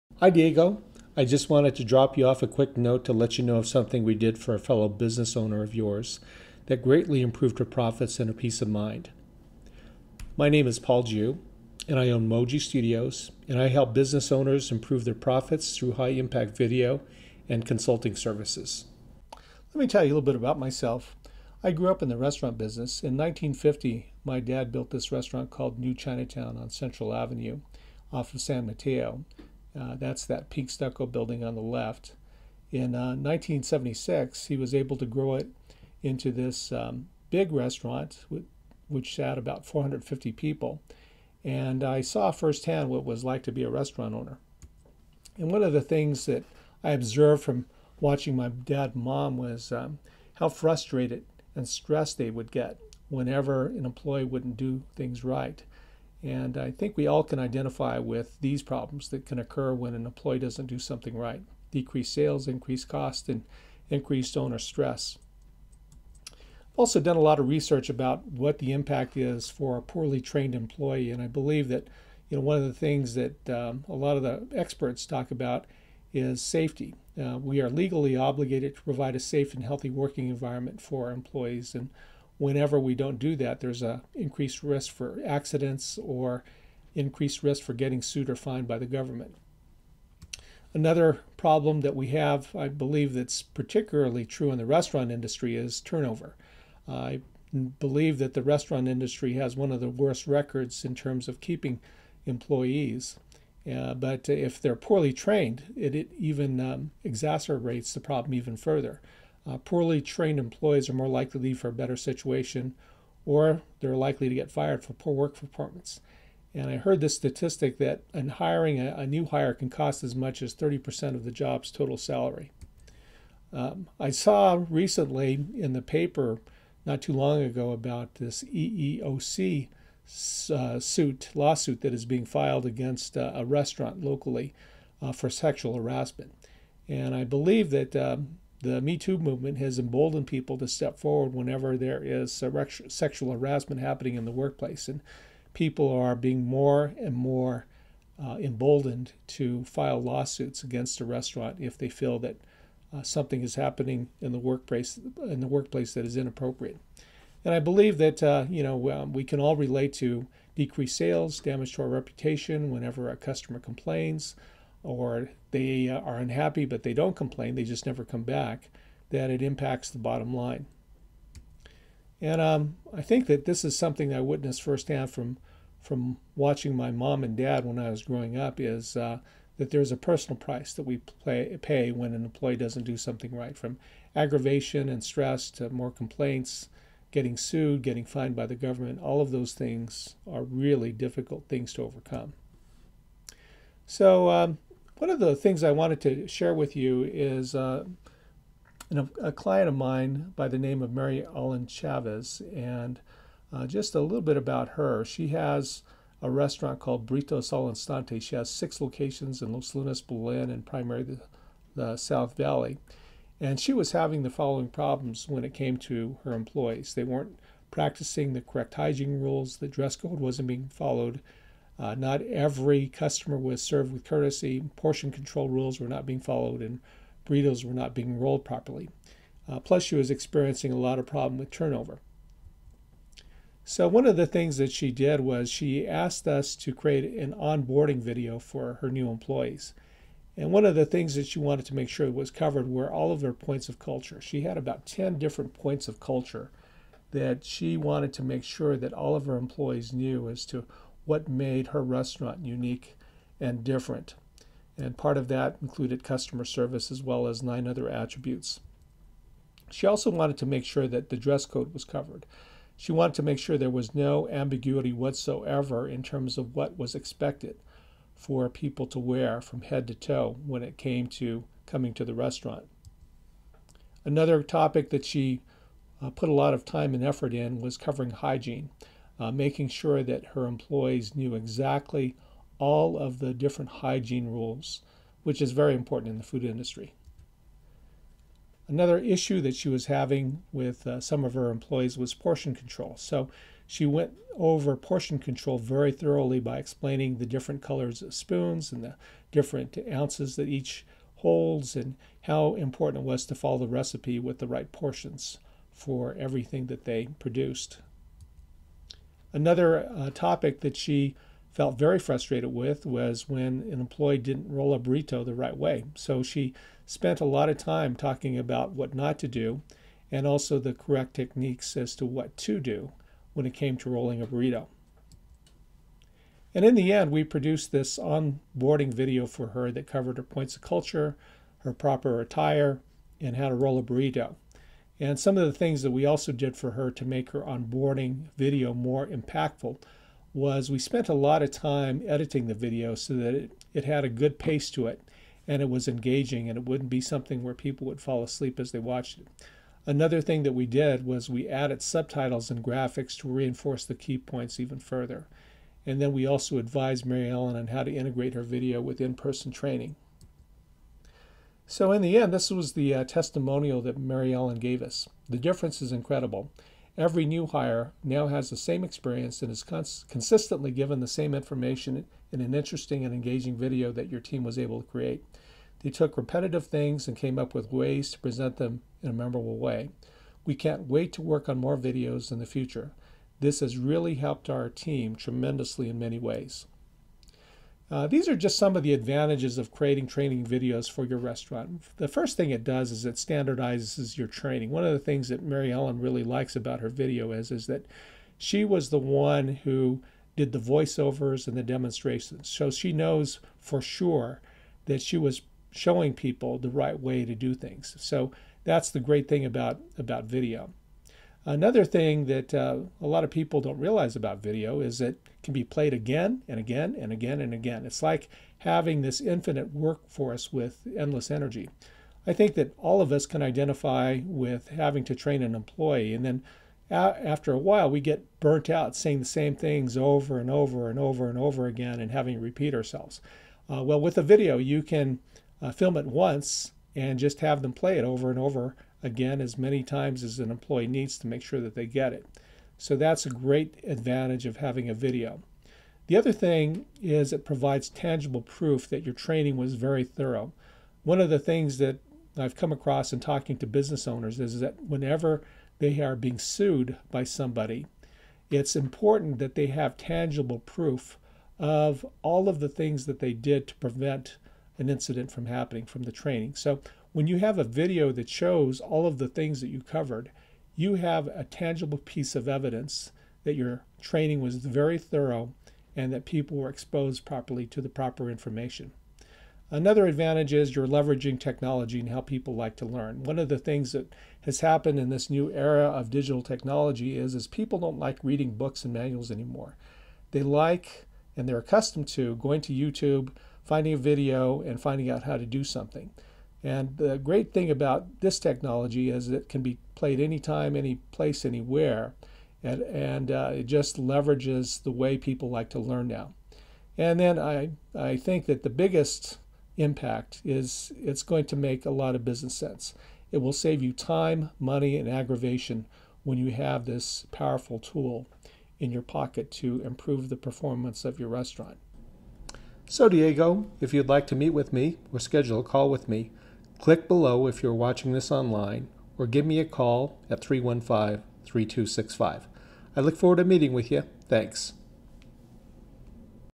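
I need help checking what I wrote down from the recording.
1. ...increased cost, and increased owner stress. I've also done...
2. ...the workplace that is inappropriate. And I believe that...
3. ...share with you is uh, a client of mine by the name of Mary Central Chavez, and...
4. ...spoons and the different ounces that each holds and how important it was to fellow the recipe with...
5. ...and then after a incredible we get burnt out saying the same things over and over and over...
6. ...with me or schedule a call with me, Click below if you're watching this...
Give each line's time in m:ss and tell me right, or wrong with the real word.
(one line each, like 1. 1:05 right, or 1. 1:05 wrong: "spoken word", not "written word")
1. 1:02 right
2. 2:35 right
3. 3:16 wrong: "Ellen", not "Central"
4. 4:58 wrong: "follow", not "fellow"
5. 7:06 wrong: "while", not "incredible"
6. 8:44 right.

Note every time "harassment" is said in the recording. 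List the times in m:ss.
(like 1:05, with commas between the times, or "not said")
2:15, 2:23.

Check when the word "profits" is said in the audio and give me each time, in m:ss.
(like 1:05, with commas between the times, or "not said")
0:07, 0:15.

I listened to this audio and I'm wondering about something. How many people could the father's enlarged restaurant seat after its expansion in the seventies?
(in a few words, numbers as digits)
450.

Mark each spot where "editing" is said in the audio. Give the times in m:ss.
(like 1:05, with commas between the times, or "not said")
5:42.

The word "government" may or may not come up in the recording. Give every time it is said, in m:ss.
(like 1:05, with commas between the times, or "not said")
1:28, 3:08.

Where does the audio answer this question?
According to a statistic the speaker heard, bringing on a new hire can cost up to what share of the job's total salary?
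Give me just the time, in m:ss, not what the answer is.
2:00.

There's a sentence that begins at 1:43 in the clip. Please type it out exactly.
Uh, but if they're poorly trained, it, it even um, exacerbates the problem even further.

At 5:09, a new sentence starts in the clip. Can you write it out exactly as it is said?
Another uh, topic that she felt very frustrated with was when an employee didn't roll a burrito the right way.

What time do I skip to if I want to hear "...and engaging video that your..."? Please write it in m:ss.
6:13.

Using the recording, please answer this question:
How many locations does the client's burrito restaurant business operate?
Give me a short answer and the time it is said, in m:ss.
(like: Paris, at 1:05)
6, at 3:28.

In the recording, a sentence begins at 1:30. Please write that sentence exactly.
Another problem that we have, I believe that's particularly true in the restaurant industry, is turnover.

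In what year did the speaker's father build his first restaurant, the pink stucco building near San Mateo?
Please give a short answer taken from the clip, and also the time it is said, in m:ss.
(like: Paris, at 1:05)
1950, at 0:23.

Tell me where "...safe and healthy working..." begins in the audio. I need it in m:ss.
1:19.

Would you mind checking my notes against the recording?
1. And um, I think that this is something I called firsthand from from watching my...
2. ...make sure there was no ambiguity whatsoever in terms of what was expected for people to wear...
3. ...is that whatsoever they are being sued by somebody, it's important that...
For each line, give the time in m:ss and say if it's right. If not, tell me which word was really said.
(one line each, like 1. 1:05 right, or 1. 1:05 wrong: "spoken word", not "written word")
1. 2:52 wrong: "witnessed", not "called"
2. 4:23 right
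3. 7:34 wrong: "whenever", not "whatsoever".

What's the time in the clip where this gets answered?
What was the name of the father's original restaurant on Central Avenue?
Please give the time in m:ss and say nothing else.
0:25.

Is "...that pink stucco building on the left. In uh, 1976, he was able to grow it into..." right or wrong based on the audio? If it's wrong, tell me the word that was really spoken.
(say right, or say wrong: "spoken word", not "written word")
right.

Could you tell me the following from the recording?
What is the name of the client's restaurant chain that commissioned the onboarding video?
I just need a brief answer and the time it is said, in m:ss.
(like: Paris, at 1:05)
Burritos Alinstante, at 3:27.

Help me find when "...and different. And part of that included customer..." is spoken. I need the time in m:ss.
4:13.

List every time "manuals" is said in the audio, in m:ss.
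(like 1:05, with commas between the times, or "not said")
8:08.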